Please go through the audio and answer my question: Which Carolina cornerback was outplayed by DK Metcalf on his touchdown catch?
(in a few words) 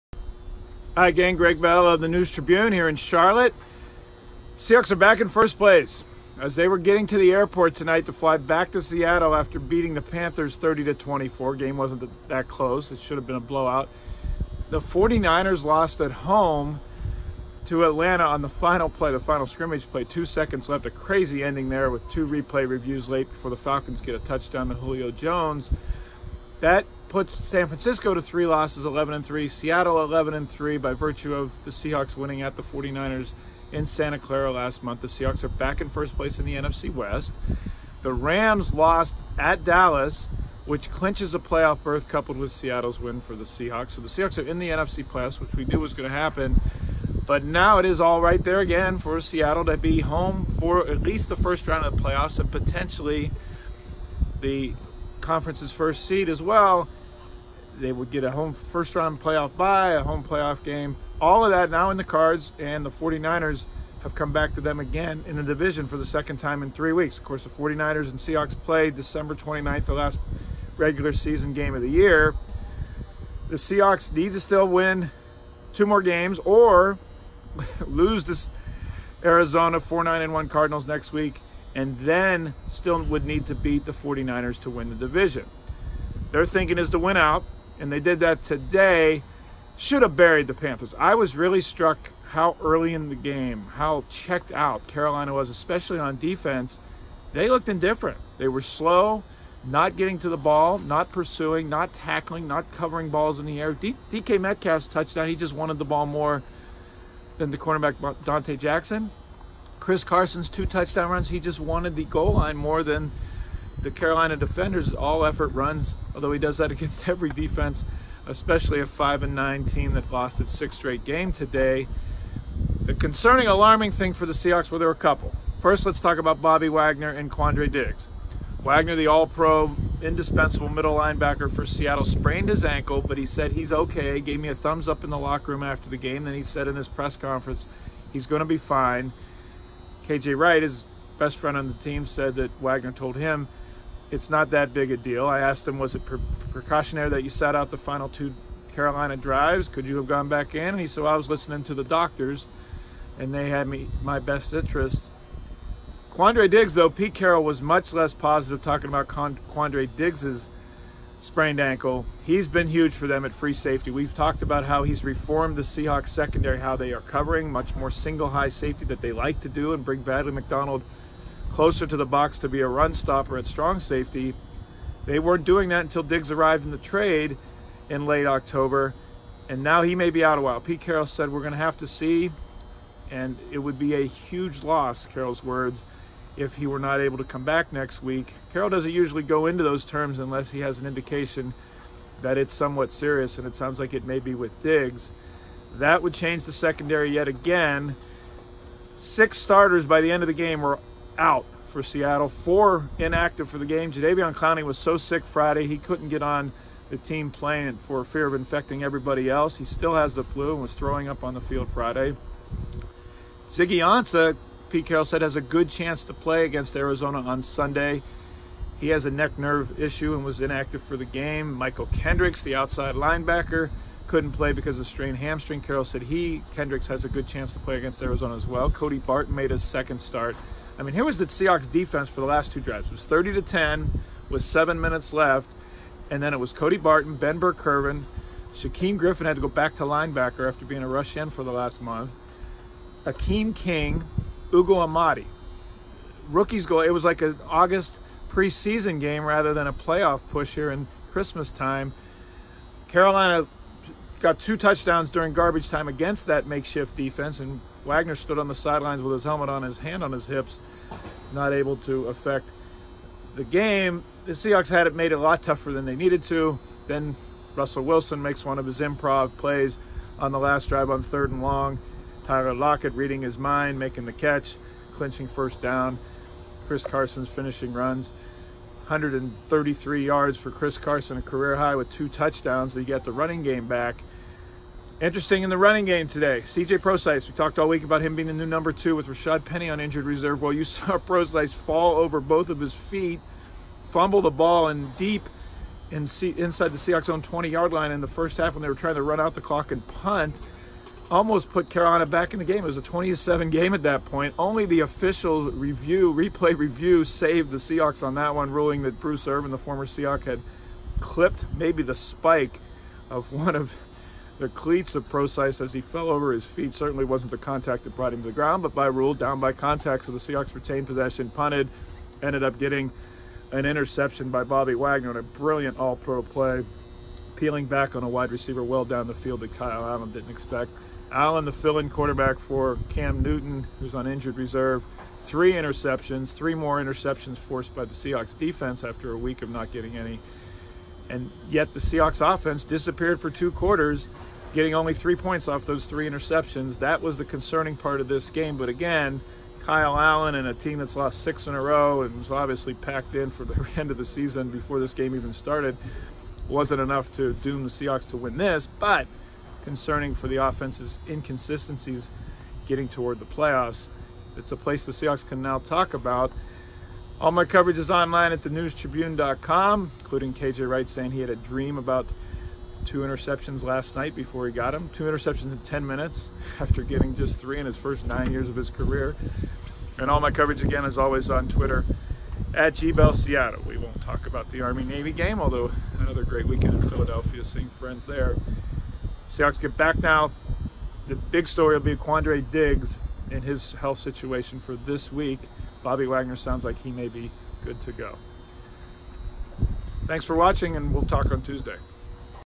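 Donte Jackson.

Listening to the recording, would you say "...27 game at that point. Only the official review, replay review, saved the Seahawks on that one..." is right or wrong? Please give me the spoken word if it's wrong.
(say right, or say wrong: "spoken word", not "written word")
right.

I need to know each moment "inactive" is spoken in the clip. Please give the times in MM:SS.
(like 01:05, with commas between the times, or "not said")
03:22, 03:40.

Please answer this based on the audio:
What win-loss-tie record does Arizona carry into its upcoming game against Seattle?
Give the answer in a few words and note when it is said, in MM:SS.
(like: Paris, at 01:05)
4-9-1, at 01:19.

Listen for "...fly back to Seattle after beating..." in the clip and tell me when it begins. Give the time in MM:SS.
00:08.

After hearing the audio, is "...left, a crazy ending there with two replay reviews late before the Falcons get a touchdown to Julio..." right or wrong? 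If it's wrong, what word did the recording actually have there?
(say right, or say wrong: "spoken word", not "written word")
right.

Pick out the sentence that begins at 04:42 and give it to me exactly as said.
He got the running game back.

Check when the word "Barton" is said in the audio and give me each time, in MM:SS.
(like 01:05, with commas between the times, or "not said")
03:48, 03:56.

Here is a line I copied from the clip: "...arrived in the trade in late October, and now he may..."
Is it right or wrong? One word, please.
right.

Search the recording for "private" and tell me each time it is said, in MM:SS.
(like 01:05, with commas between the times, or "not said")
not said.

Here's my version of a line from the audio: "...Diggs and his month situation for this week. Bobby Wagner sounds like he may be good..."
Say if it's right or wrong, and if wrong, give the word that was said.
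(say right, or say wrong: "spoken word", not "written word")
wrong: "health", not "month".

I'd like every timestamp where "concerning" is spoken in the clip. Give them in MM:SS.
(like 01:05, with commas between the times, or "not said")
02:02, 05:47, 05:59.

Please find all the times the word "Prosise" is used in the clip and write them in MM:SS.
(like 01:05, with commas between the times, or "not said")
04:46, 04:50, 05:15.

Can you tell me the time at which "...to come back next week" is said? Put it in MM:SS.
03:07.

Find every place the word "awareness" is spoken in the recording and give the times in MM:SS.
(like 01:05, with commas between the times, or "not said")
not said.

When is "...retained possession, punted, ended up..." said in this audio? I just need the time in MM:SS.
05:20.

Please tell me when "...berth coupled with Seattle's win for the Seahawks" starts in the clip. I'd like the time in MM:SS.
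00:41.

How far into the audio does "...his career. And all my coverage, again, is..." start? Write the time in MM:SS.
06:18.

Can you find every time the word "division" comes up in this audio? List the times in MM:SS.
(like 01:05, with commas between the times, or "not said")
01:05, 01:24.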